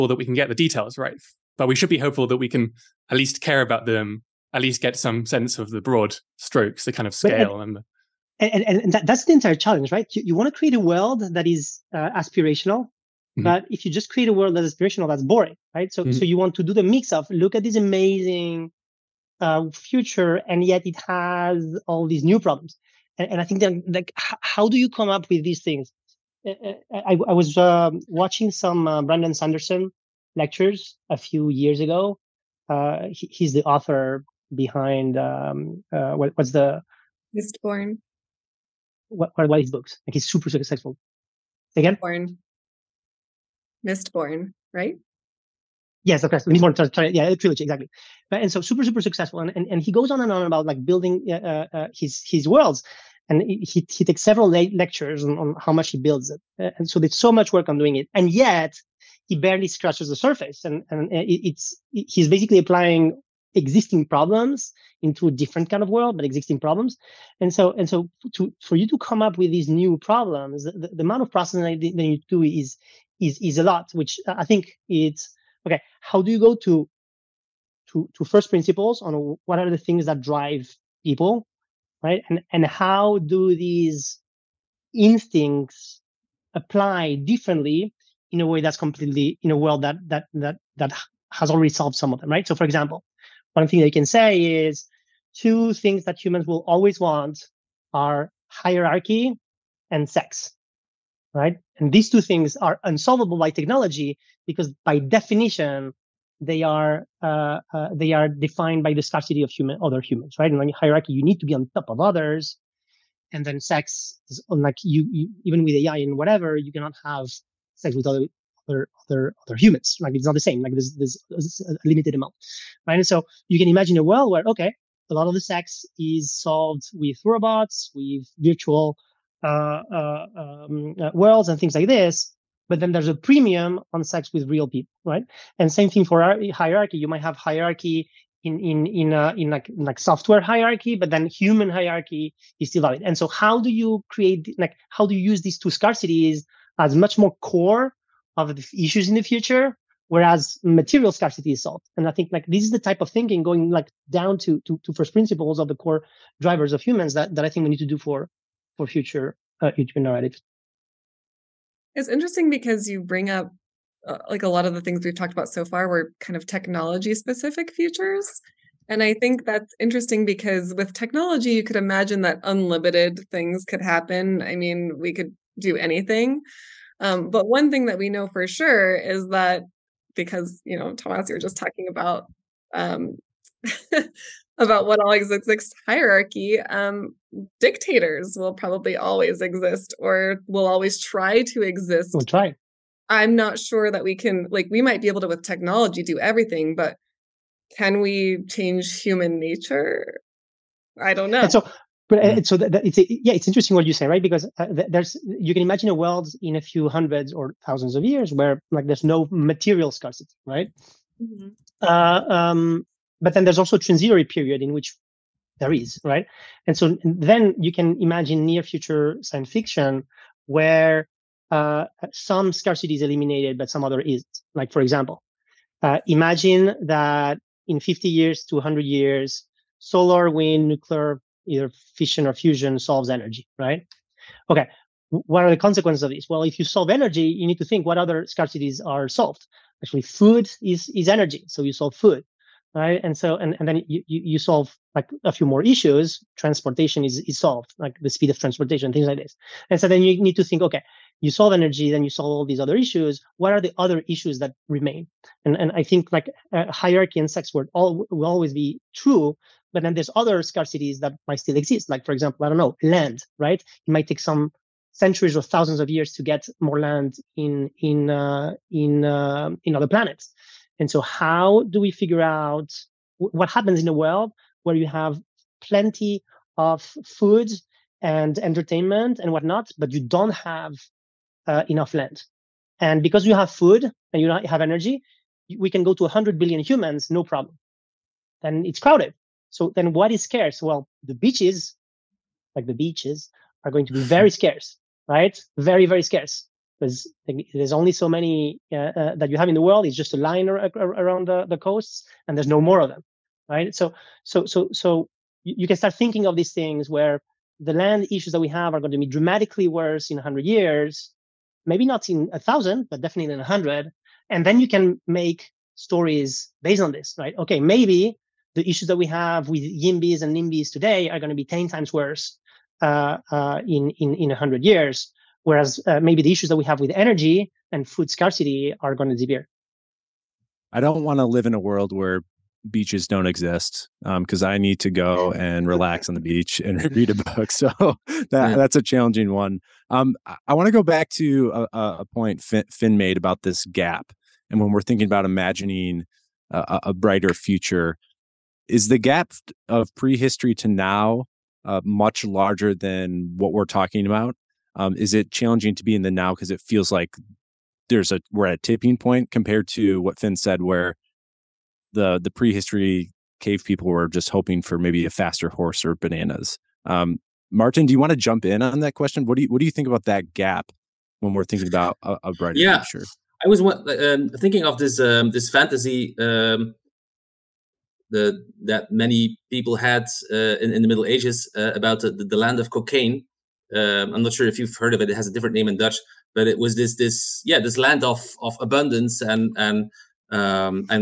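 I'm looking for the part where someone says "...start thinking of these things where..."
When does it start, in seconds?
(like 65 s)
305 s.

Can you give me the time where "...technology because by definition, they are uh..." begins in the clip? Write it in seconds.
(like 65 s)
103 s.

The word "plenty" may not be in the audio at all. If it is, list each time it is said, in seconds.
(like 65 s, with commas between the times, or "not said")
275 s.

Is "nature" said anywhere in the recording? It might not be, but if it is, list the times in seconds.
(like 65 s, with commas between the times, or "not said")
199 s.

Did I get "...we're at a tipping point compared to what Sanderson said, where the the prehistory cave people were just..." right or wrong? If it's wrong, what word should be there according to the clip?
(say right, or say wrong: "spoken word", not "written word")
wrong: "Fin", not "Sanderson".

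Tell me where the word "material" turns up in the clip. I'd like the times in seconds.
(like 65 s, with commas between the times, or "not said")
150 s, 209 s.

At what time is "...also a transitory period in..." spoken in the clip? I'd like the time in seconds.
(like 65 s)
213 s.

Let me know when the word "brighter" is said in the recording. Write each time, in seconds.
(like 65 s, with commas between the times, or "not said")
346 s, 372 s.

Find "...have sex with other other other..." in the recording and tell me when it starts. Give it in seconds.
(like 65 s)
117 s.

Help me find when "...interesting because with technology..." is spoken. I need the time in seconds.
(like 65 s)
169 s.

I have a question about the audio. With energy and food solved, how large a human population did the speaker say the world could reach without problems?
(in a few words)
100 billion.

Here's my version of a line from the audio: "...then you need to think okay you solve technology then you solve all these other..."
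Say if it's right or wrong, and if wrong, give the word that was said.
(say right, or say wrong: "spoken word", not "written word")
wrong: "energy", not "technology".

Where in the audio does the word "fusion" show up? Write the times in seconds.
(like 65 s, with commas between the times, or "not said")
232 s.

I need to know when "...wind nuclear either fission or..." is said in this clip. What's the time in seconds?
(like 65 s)
230 s.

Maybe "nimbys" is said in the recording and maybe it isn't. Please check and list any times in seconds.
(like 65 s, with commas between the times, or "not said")
320 s.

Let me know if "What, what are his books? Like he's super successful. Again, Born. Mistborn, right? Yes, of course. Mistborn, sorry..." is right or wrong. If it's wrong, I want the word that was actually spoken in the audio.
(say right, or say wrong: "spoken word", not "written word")
right.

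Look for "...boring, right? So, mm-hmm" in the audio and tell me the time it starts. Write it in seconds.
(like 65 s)
15 s.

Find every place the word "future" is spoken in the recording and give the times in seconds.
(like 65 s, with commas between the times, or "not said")
19 s, 149 s, 158 s, 167 s, 218 s, 347 s, 372 s.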